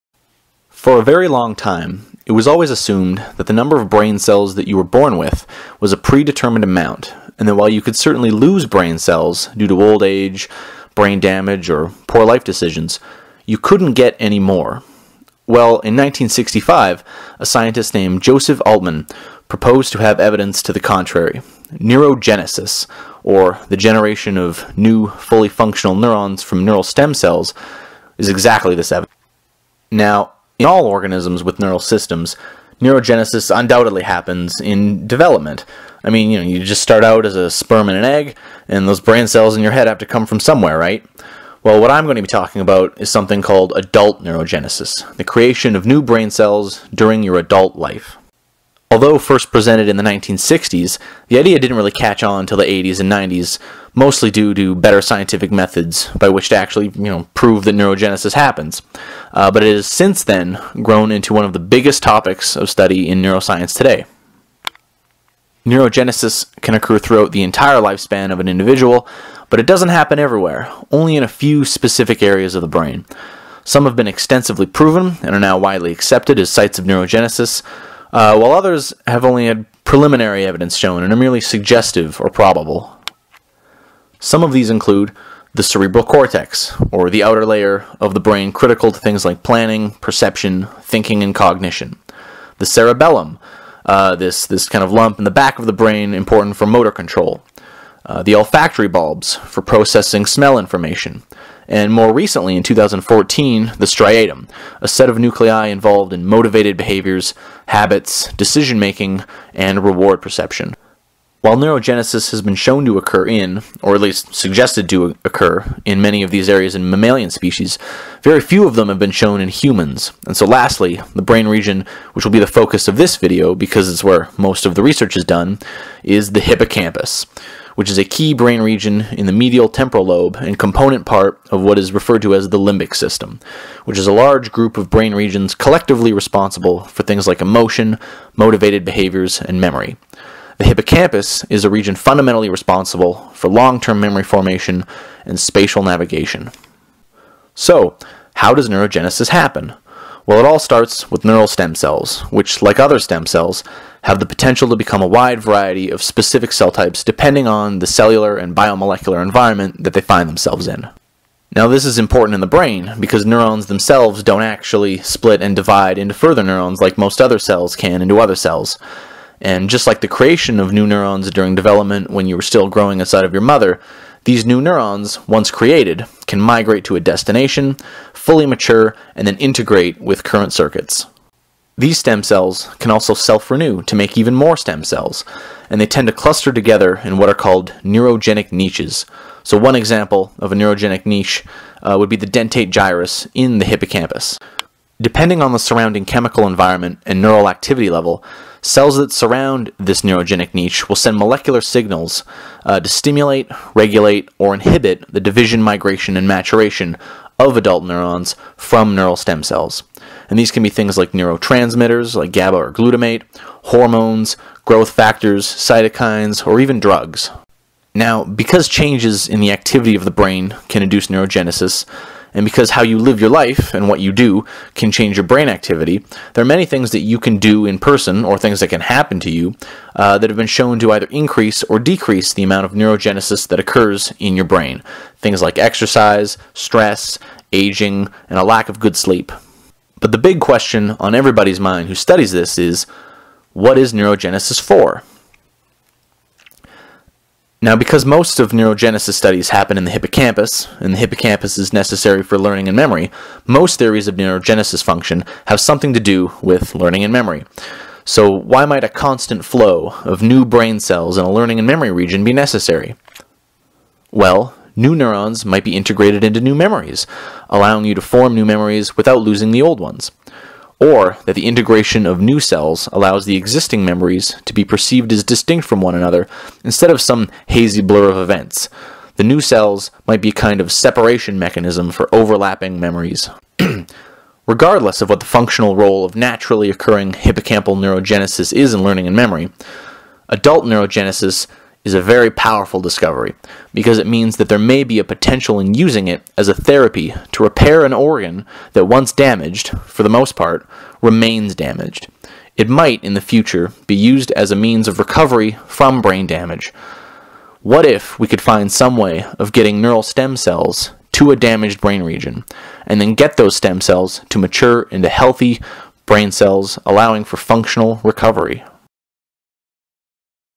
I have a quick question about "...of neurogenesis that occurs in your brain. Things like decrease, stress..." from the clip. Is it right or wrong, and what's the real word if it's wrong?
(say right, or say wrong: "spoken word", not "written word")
wrong: "exercise", not "decrease".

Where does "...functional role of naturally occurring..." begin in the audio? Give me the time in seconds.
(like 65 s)
285 s.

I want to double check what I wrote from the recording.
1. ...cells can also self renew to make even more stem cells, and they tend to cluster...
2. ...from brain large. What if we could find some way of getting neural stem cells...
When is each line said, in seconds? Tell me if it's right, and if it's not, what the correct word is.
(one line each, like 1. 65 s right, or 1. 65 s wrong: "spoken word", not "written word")
1. 182 s right
2. 305 s wrong: "damage", not "large".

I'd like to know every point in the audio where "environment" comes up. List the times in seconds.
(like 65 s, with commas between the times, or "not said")
159 s, 196 s.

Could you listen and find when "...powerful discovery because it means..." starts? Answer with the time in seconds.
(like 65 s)
292 s.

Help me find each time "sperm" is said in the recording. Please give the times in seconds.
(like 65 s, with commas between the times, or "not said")
37 s.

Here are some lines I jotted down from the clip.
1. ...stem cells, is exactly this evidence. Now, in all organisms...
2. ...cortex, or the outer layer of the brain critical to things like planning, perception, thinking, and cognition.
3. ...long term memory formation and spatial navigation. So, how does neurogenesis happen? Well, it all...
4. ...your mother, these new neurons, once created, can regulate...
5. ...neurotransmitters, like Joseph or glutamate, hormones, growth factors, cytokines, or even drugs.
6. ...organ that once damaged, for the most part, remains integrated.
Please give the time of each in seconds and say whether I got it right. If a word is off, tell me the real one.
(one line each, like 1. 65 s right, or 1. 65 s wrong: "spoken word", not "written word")
1. 26 s right
2. 86 s right
3. 143 s right
4. 173 s wrong: "migrate", not "regulate"
5. 211 s wrong: "GABA", not "Joseph"
6. 297 s wrong: "damaged", not "integrated".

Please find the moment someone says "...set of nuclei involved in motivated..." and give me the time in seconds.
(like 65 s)
104 s.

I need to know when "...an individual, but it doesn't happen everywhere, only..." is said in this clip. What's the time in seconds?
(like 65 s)
68 s.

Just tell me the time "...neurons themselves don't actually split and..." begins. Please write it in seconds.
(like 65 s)
163 s.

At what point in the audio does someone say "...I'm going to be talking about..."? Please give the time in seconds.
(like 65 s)
41 s.